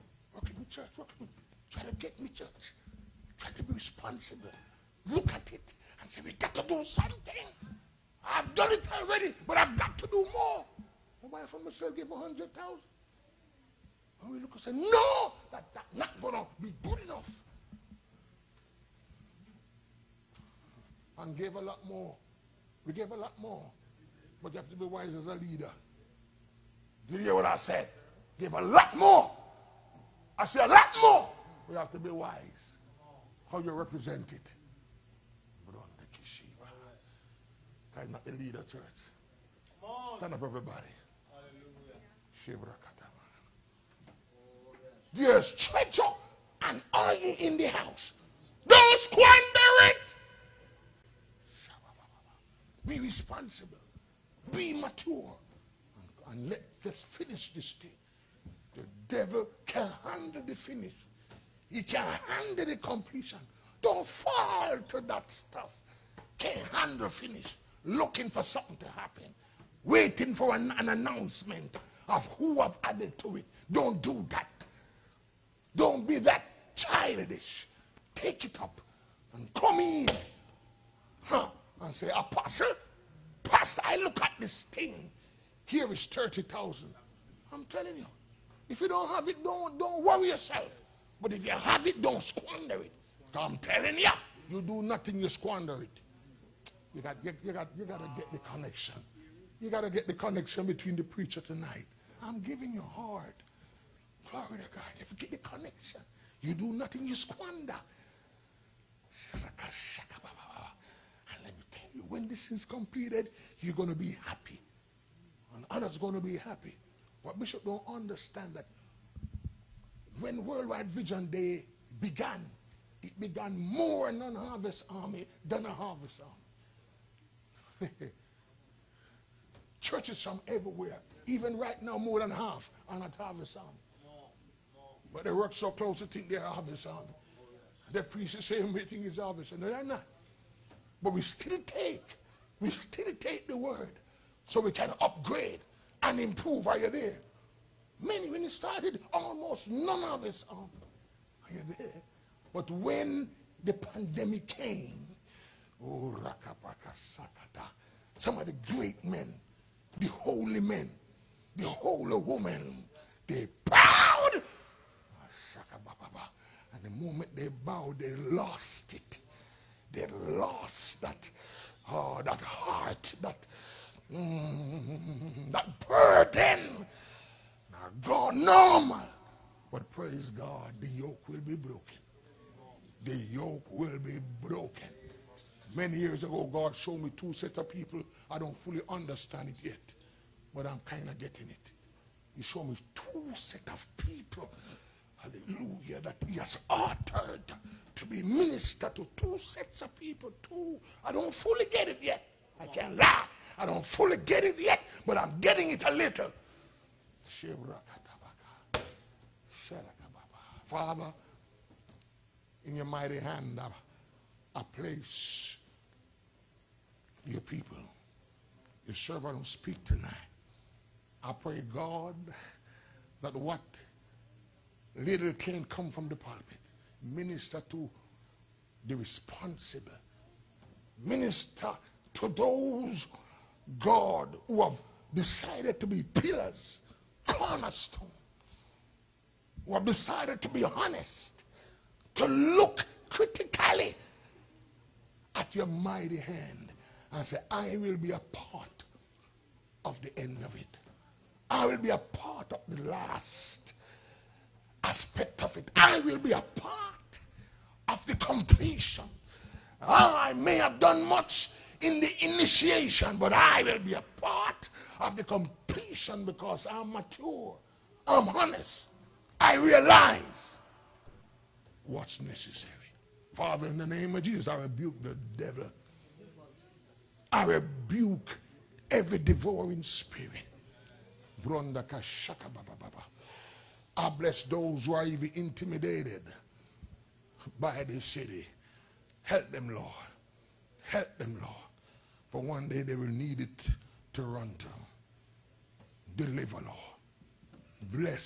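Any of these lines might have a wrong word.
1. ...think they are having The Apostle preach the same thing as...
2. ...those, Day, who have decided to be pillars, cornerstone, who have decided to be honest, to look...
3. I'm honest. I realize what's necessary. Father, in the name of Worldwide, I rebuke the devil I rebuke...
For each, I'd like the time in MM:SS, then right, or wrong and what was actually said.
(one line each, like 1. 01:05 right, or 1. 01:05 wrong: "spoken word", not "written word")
1. 02:16 wrong: "They", not "Apostle"
2. 03:52 wrong: "God", not "Day"
3. 04:28 wrong: "Jesus", not "Worldwide".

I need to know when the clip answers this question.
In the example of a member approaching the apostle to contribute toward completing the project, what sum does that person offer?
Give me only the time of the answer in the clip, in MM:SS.
01:26.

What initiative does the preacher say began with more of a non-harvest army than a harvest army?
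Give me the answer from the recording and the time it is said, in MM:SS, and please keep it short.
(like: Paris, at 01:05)
Worldwide Vision Day, at 02:00.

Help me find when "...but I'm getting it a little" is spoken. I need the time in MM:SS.
03:25.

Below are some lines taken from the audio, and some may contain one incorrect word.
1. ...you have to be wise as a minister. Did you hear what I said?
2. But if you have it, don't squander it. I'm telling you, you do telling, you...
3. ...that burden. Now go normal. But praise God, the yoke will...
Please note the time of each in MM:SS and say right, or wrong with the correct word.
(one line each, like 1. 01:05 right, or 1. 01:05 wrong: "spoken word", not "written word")
1. 00:24 wrong: "leader", not "minister"
2. 01:31 wrong: "nothing", not "telling"
3. 02:55 right.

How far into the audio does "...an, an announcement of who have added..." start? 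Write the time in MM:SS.
01:10.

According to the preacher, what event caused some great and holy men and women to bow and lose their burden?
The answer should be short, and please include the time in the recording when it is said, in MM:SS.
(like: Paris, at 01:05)
The pandemic, at 02:33.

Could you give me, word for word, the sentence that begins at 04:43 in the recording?
I bless those who are even intimidated by this city.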